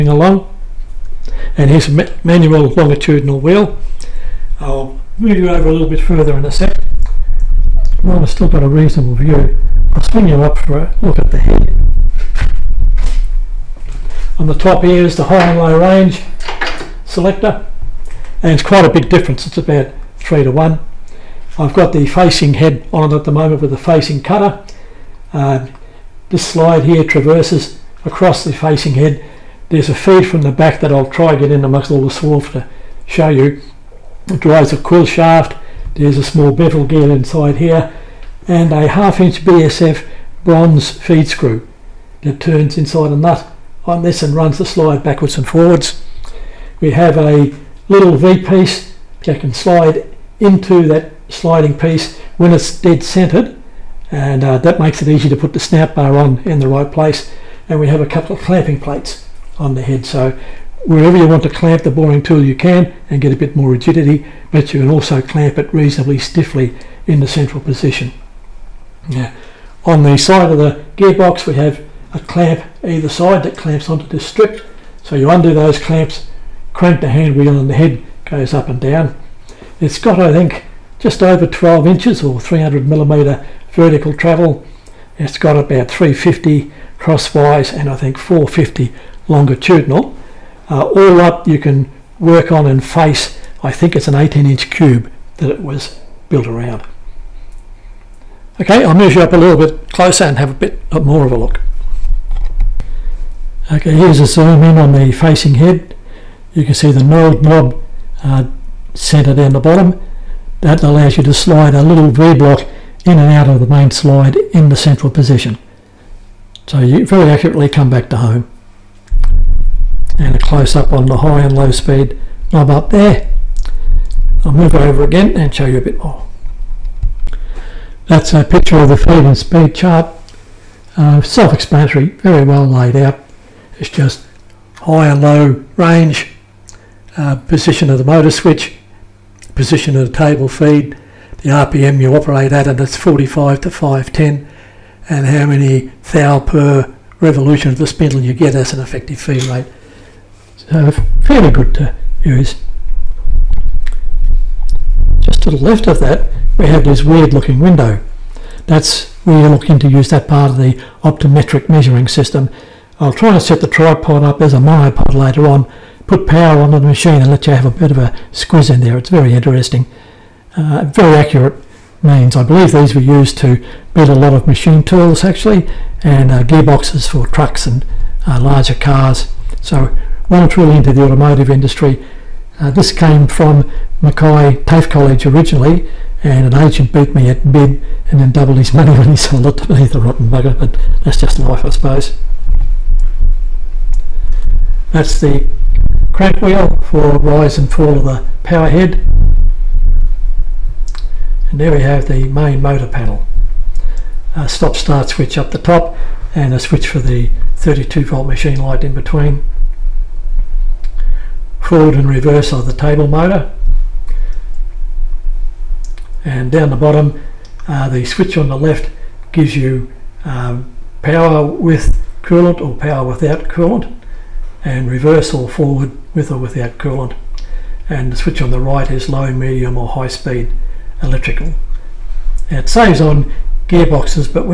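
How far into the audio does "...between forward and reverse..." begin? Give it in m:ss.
3:28.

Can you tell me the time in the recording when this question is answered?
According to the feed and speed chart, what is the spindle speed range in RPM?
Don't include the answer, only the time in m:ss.
2:22.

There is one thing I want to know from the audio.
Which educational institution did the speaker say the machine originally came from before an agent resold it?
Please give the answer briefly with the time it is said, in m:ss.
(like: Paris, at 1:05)
Mackay TAFE College, at 3:04.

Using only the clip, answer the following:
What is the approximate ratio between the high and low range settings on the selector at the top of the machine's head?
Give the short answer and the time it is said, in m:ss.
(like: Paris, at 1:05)
3 to 1, at 0:20.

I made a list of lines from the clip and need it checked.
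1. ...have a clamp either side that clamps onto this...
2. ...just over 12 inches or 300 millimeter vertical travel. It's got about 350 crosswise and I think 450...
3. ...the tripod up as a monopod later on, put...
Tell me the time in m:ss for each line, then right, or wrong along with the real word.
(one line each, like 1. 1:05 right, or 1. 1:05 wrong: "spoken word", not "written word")
1. 1:11 right
2. 1:20 right
3. 2:43 right.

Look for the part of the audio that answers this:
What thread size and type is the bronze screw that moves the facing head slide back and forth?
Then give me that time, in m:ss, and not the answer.
0:38.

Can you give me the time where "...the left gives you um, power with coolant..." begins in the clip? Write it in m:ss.
3:38.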